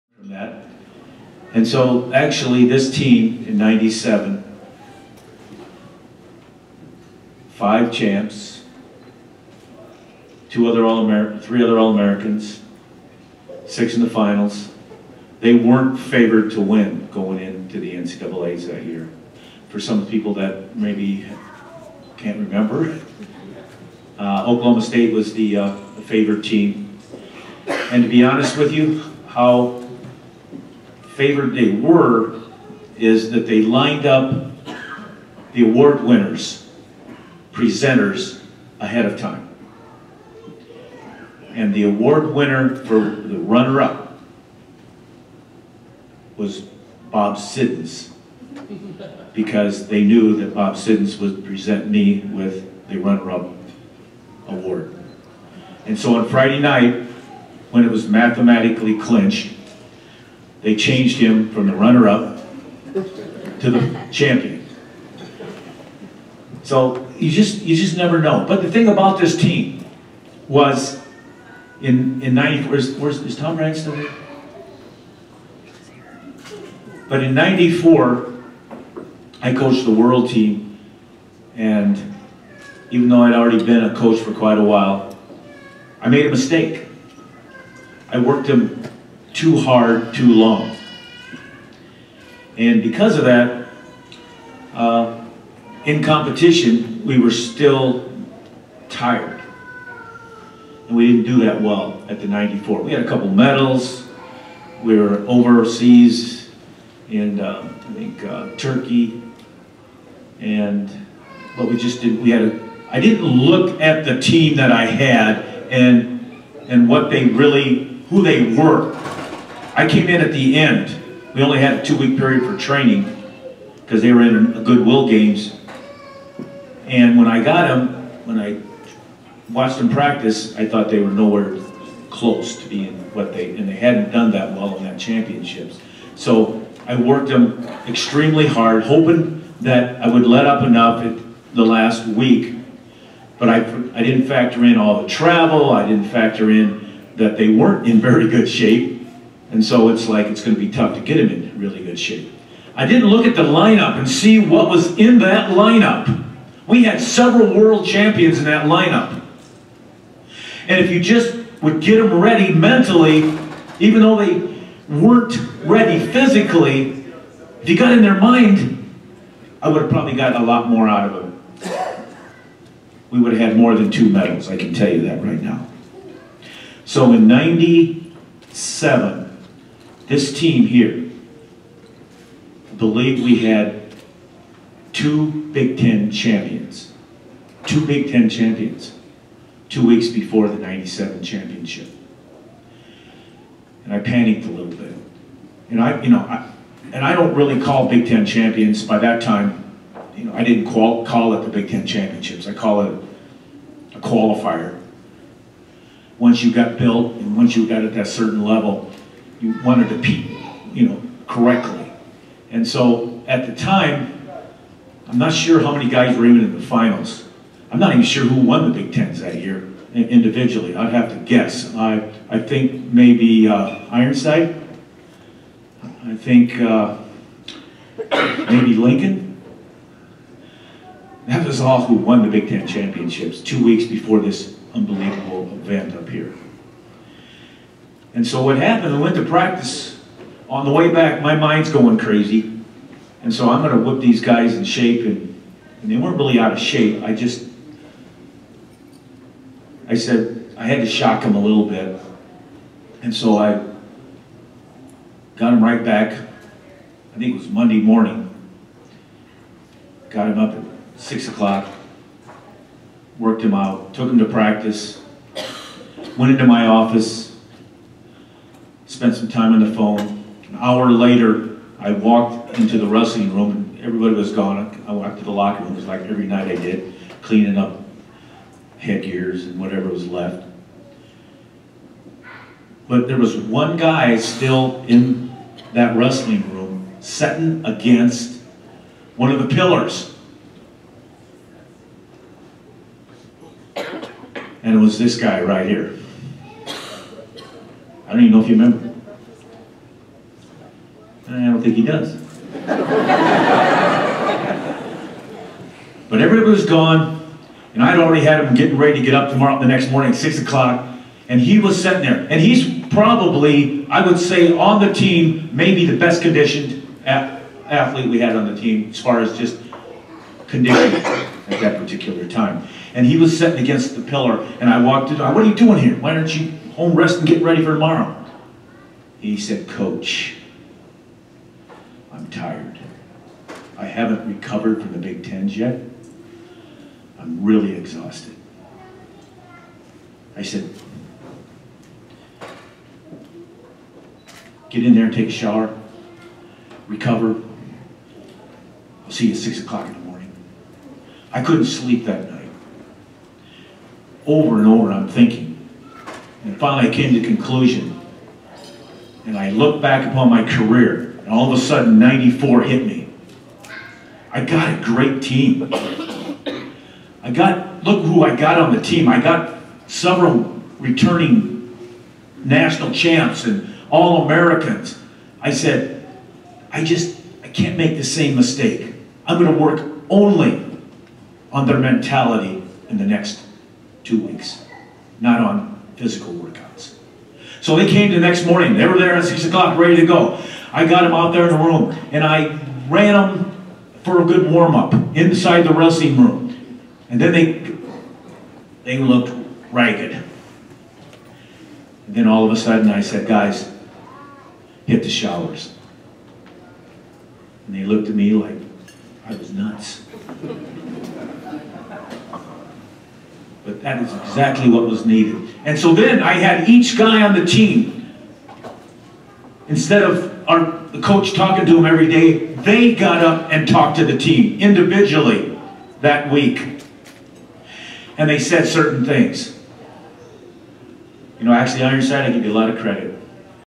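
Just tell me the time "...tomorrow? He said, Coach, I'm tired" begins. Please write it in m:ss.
5:27.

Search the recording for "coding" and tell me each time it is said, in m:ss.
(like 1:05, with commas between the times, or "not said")
not said.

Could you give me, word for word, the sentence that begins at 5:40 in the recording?
I said, get in there and take a shower, recover.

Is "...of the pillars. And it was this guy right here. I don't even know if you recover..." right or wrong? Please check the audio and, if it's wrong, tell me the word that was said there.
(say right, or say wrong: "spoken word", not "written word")
wrong: "remember", not "recover".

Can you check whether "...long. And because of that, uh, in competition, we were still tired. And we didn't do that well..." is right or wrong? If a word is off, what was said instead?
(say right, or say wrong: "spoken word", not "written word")
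right.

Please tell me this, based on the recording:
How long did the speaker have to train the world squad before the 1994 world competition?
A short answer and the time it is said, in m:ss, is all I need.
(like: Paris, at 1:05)
2 weeks, at 2:01.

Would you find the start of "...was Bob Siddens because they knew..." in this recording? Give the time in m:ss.
0:46.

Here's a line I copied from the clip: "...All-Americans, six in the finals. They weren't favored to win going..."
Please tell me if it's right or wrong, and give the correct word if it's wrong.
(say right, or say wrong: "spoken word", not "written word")
right.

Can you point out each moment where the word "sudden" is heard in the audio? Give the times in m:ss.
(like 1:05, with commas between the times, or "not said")
6:01, 6:42.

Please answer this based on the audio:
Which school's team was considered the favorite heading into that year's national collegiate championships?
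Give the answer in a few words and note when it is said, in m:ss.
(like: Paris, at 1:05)
Oklahoma State, at 0:24.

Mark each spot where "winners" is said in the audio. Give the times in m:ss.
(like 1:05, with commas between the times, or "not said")
0:36, 0:42.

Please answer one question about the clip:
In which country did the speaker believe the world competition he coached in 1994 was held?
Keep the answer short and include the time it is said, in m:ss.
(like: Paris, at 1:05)
Turkey, at 1:48.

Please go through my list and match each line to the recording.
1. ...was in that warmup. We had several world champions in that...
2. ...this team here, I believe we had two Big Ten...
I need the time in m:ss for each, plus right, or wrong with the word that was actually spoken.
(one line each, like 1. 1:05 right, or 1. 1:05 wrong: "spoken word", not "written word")
1. 2:34 wrong: "lineup", not "warmup"
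2. 3:00 right.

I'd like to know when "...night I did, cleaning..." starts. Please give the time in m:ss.
4:36.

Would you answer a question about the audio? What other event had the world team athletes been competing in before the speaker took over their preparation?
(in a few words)
Goodwill Games.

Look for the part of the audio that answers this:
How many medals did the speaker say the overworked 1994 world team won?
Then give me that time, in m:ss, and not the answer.
2:53.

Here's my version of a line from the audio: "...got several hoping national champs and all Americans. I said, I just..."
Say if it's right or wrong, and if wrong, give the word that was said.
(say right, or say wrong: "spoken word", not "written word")
wrong: "returning", not "hoping".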